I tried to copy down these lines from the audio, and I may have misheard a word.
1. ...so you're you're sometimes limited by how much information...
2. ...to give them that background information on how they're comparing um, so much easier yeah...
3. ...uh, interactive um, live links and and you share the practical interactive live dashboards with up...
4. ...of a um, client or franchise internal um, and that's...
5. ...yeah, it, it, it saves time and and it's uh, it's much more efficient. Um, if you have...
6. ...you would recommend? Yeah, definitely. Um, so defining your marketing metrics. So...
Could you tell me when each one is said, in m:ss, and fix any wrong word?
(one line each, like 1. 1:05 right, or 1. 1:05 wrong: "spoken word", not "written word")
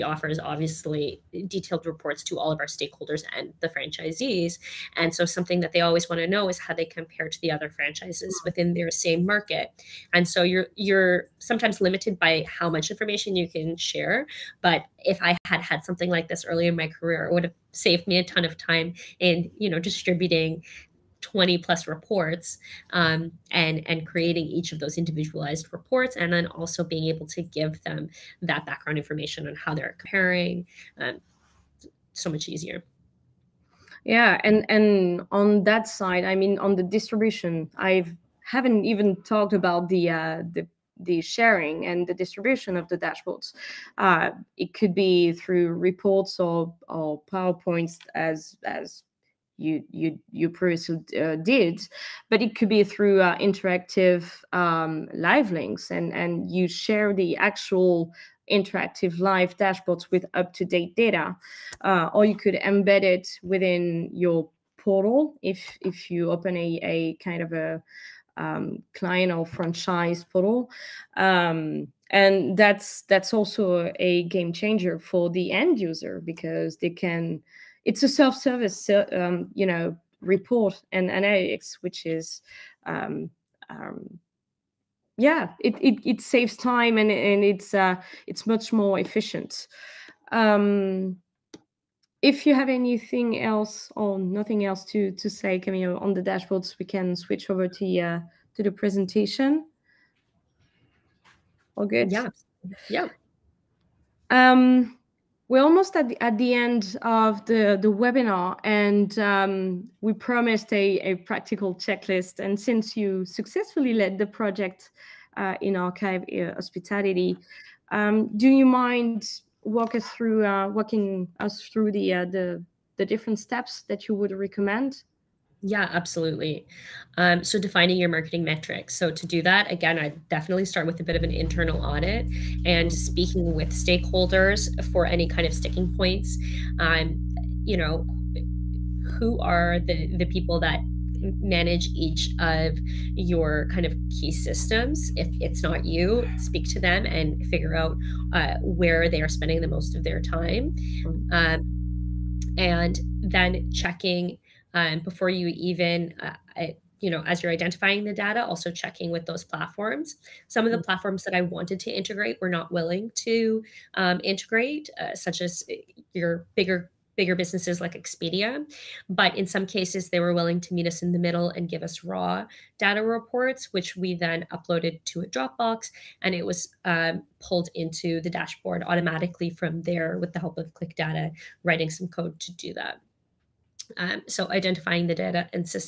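1. 0:10 right
2. 0:27 right
3. 0:53 wrong: "actual", not "practical"
4. 1:07 wrong: "portal", not "internal"
5. 1:25 right
6. 2:04 wrong: "absolutely", not "definitely".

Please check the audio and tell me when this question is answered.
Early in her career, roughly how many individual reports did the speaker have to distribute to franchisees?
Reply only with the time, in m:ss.
0:21.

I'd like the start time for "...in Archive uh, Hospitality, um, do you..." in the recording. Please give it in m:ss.
1:55.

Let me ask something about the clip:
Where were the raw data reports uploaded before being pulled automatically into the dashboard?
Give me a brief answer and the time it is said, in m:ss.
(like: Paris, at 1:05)
Dropbox, at 2:55.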